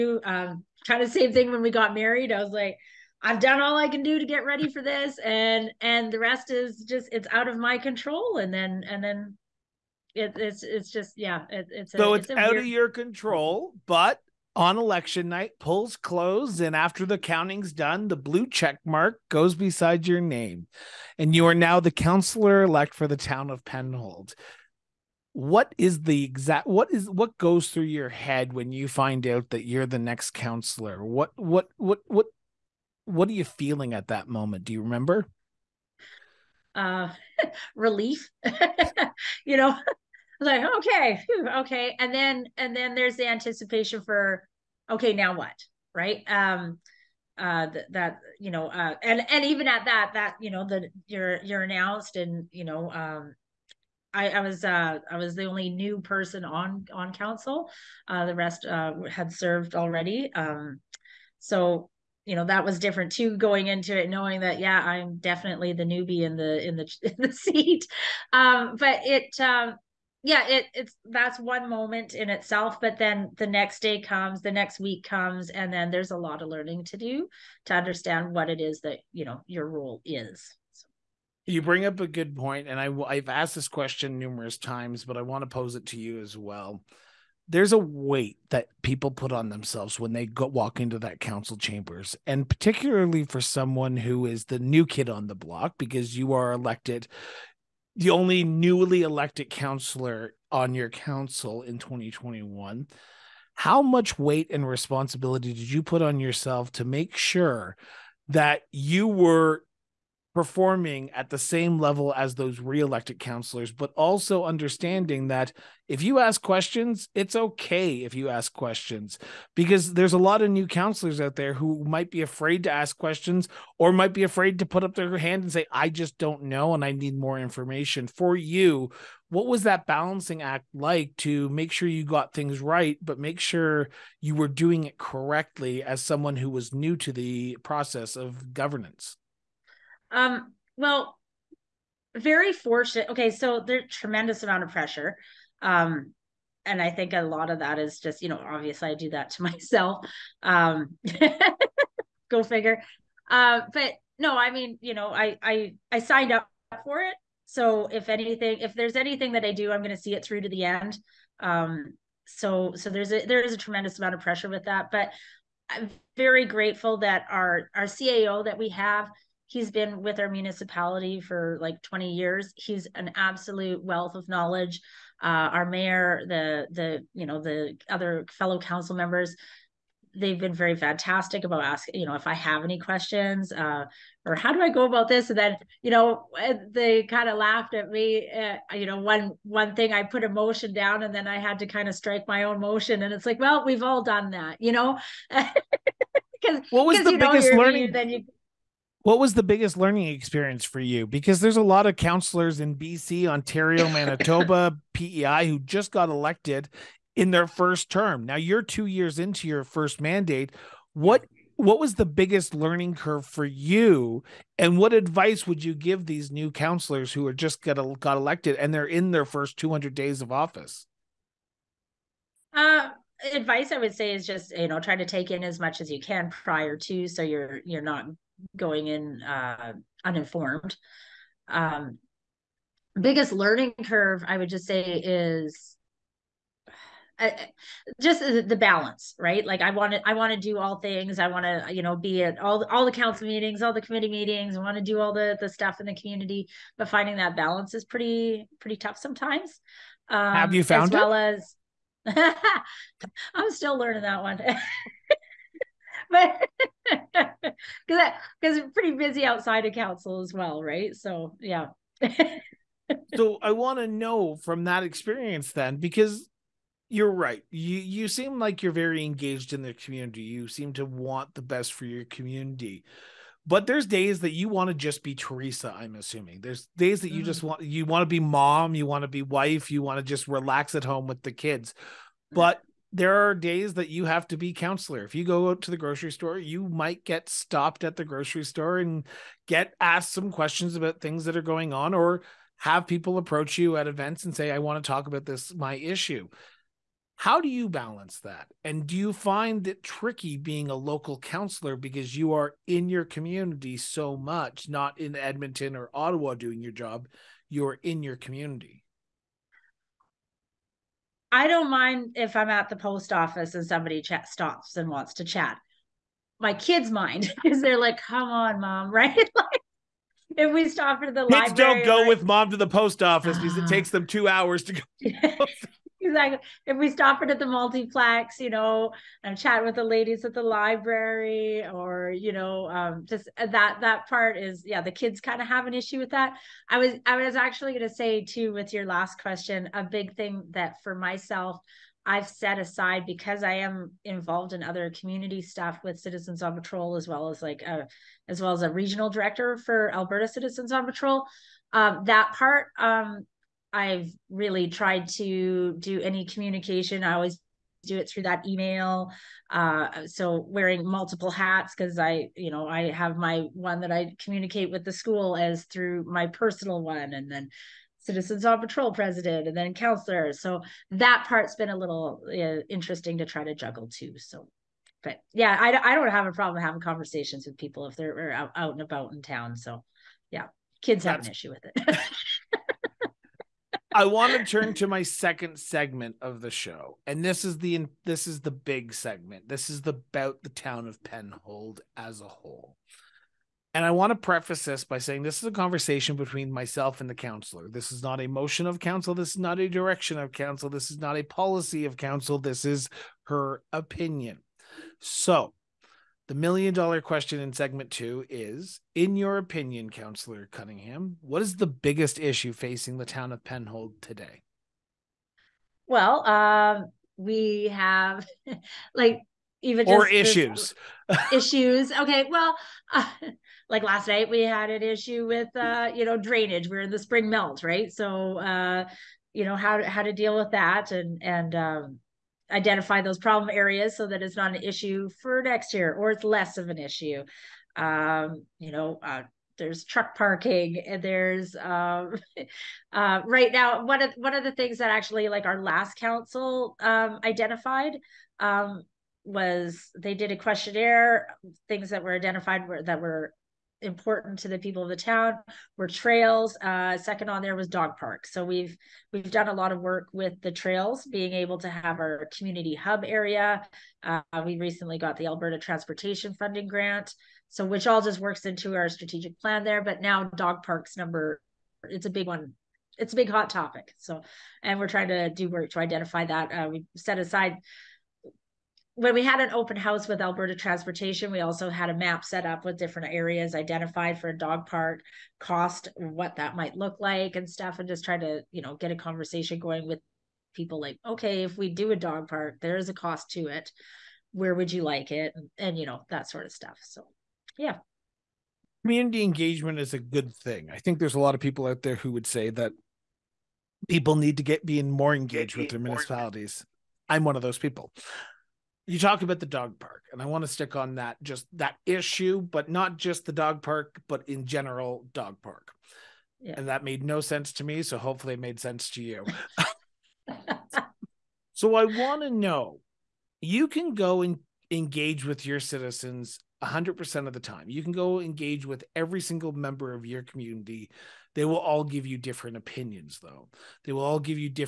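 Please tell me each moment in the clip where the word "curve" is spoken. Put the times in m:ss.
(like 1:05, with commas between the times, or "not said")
3:32, 3:53.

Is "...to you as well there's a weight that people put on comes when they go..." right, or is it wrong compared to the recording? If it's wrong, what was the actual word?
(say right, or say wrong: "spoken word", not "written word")
wrong: "themselves", not "comes".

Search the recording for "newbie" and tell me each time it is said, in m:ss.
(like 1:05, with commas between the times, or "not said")
1:05.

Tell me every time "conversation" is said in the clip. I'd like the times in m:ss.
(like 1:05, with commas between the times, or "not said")
6:16, 6:35, 8:08.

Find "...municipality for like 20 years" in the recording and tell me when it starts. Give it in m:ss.
2:50.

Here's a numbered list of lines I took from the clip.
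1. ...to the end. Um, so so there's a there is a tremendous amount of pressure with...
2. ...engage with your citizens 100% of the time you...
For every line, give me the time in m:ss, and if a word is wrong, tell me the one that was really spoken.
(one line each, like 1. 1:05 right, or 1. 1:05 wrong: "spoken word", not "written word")
1. 2:40 right
2. 8:44 right.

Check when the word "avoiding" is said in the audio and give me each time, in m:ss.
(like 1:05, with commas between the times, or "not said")
not said.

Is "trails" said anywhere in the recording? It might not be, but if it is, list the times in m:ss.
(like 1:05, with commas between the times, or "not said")
7:35, 7:40.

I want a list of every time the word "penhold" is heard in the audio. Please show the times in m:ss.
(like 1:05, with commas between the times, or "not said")
0:23, 6:31, 6:53.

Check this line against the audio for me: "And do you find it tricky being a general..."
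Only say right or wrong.
wrong.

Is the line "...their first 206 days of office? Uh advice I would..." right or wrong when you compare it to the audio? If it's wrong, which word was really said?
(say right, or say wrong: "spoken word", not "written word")
wrong: "200", not "206".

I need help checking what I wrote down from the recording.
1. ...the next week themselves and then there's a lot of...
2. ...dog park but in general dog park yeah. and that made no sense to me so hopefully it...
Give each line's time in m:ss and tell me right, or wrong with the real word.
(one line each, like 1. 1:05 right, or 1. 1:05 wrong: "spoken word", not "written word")
1. 1:14 wrong: "comes", not "themselves"
2. 8:33 right.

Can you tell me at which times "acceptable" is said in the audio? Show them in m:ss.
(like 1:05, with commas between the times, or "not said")
not said.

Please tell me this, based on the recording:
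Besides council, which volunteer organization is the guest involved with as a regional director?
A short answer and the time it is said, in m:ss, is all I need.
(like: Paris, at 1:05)
Alberta Citizens on Patrol, at 5:49.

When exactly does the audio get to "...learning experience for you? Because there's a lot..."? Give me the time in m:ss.
3:19.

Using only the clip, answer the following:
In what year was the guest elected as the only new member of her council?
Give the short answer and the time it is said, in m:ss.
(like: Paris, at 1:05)
2021, at 1:41.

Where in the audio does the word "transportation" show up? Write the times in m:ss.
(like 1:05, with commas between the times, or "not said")
7:45, 8:00.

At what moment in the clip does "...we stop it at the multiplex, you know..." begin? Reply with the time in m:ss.
5:26.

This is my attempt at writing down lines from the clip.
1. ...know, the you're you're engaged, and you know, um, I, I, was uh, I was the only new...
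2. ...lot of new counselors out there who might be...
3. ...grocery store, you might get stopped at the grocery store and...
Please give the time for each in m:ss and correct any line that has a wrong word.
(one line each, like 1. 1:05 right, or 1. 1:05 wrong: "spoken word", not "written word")
1. 0:50 wrong: "announced", not "engaged"
2. 2:00 right
3. 4:45 right.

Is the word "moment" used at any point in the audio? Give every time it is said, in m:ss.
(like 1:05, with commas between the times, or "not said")
0:34, 1:11.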